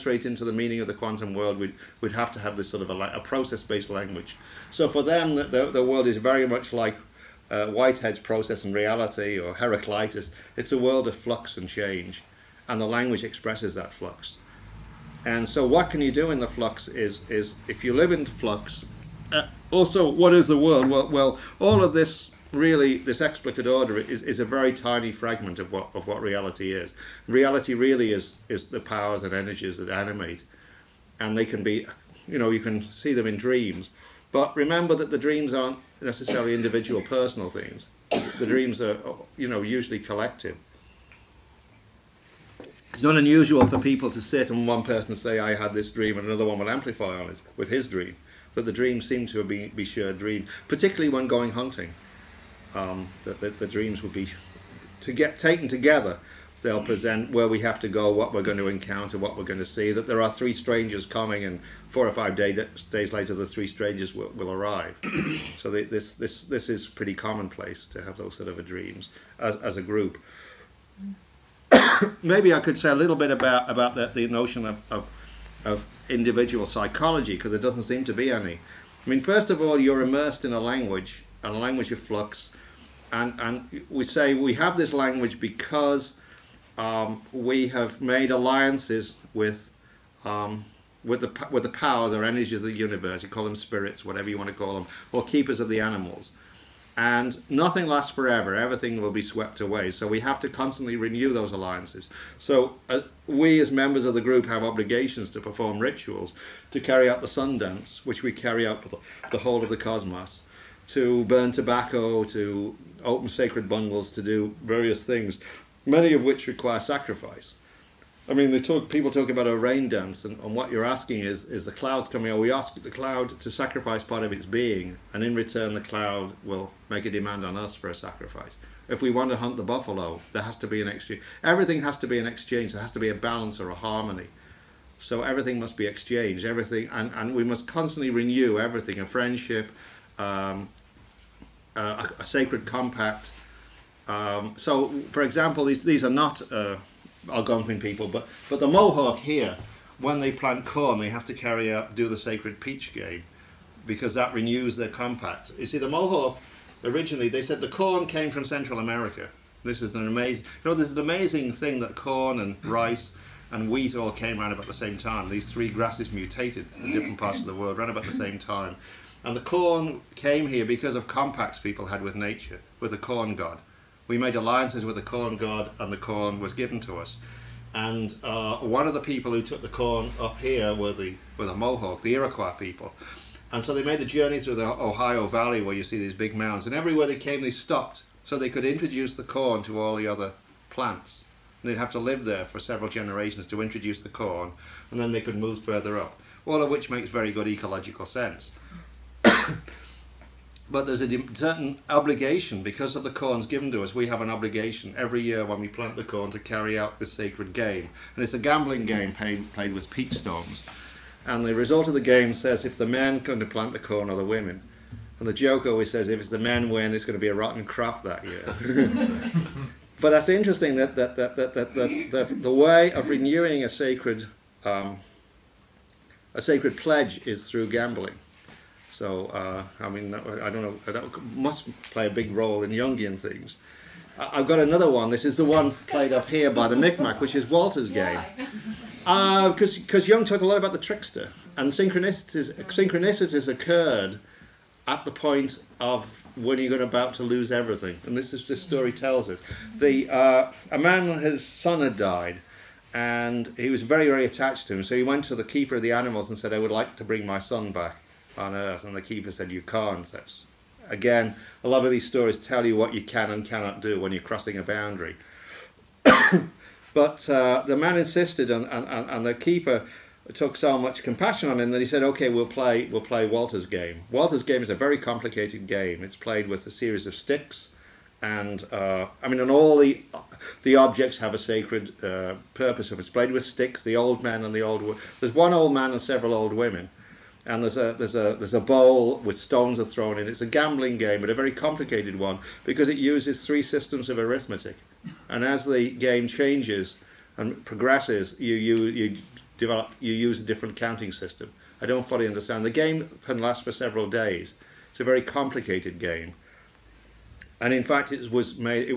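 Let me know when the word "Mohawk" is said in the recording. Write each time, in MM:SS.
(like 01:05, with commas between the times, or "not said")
02:28, 02:35, 03:01.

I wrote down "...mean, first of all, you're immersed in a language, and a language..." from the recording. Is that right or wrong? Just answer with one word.
right.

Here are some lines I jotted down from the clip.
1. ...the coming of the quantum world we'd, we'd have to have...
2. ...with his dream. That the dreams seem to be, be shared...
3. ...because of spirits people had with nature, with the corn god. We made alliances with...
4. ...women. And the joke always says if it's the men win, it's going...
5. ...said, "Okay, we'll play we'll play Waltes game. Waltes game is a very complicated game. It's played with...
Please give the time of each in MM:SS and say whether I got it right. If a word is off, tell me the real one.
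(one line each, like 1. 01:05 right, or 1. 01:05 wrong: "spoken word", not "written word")
1. 00:00 wrong: "meaning", not "coming"
2. 00:47 right
3. 02:50 wrong: "compacts", not "spirits"
4. 03:34 right
5. 04:31 right.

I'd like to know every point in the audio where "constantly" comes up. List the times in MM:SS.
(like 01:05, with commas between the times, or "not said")
01:40, 02:17.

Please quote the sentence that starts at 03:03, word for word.
And so they made the journey through the Ohio Valley, where you see these big mounds.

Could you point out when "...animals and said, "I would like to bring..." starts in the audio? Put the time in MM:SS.
04:15.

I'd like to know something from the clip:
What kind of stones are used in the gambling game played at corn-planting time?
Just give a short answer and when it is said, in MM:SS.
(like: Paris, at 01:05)
Peach stones, at 03:29.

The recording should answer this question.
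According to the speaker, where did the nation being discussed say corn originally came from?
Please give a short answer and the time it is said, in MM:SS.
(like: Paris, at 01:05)
Central America, at 02:38.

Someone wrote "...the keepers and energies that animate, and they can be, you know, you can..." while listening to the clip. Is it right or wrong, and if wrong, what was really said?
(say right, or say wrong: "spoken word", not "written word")
wrong: "powers", not "keepers".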